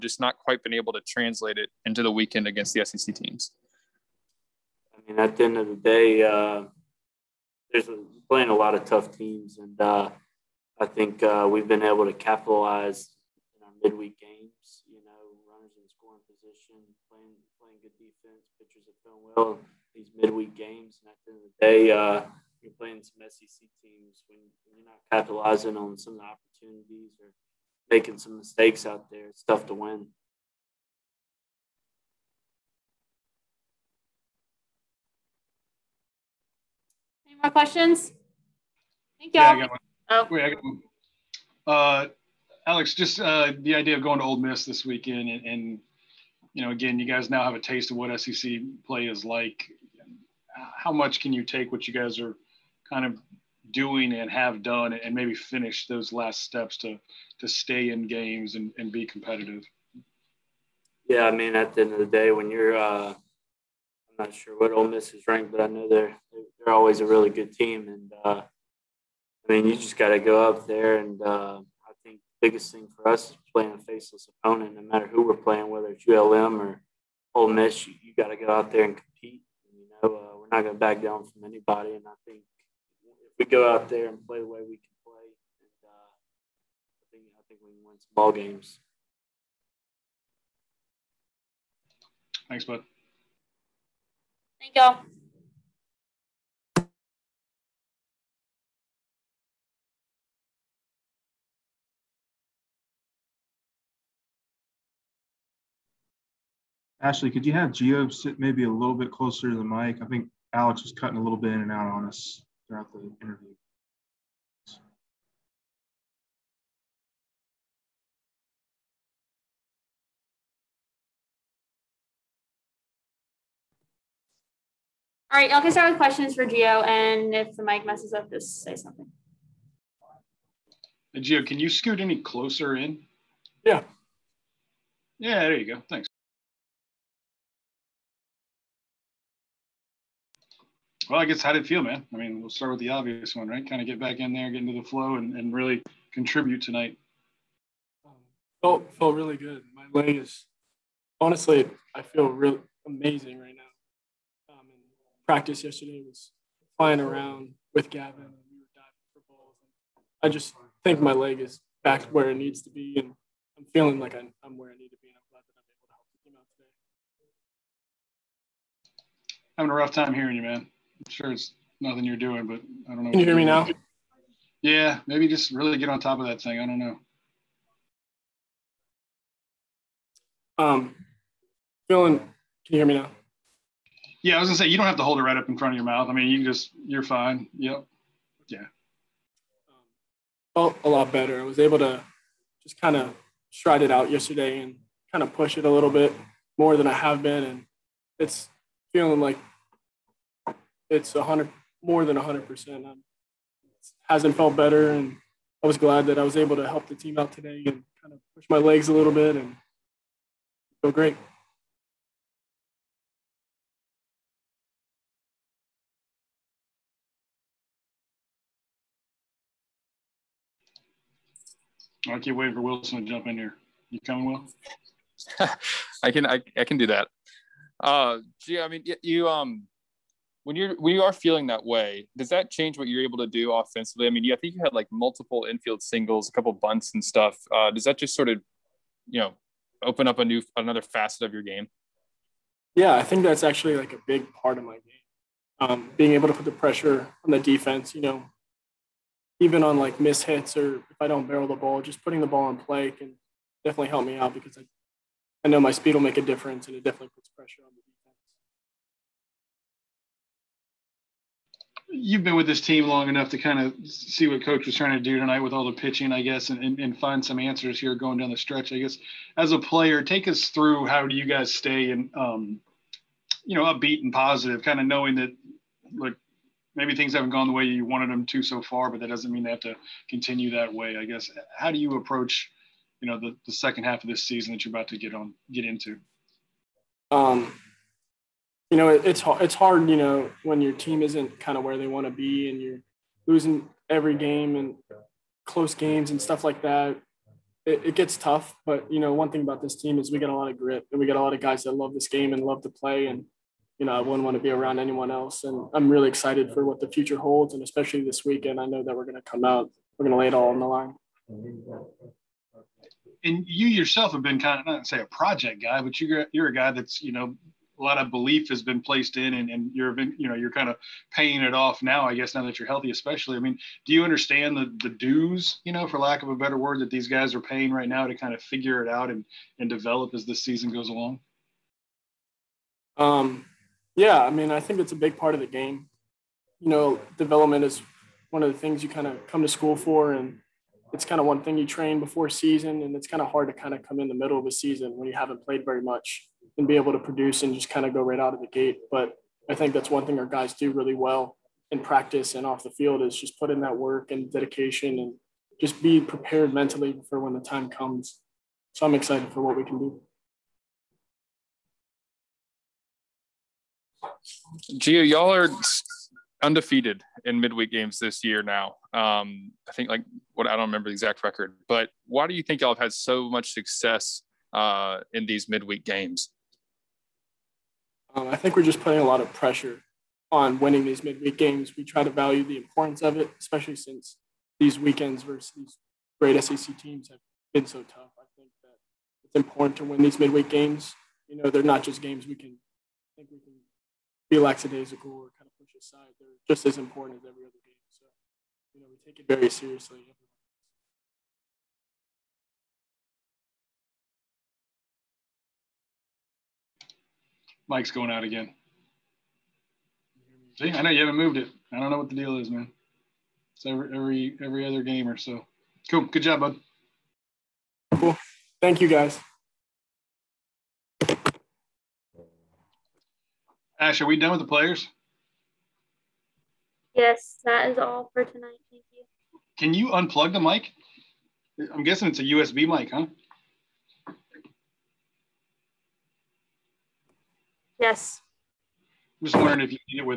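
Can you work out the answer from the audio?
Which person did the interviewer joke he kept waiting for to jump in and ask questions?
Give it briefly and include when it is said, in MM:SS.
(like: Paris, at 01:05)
Wilson, at 03:42.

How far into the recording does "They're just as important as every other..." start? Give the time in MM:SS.
06:36.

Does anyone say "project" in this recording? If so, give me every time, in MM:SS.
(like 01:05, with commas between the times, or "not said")
05:15.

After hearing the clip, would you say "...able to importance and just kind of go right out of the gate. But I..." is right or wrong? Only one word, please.
wrong.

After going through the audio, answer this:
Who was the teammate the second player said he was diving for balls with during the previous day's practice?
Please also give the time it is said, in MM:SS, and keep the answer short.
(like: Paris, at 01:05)
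Gavin, at 02:37.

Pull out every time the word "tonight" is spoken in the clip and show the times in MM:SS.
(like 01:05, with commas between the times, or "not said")
02:26, 04:25, 07:08.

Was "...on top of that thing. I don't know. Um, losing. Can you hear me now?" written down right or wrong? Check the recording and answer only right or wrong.
wrong.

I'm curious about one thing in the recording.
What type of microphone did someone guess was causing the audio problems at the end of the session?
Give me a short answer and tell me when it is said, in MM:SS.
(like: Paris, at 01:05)
USB mic, at 07:12.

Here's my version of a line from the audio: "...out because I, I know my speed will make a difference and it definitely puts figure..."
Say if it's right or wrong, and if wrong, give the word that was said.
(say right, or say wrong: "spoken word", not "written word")
wrong: "pressure", not "figure".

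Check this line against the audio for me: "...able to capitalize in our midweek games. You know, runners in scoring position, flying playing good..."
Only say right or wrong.
wrong.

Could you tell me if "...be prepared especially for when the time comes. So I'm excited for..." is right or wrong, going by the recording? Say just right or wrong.
wrong.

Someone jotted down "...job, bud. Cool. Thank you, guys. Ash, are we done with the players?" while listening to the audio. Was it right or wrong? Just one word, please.
right.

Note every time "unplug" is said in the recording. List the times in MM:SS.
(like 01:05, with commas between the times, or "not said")
07:09.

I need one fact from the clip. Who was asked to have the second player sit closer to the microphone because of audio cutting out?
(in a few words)
Ashley.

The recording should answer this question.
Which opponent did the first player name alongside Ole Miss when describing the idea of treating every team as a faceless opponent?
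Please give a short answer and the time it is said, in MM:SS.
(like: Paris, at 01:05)
ULM, at 01:16.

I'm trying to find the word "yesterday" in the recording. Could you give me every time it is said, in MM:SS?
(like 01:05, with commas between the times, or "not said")
02:35, 03:14.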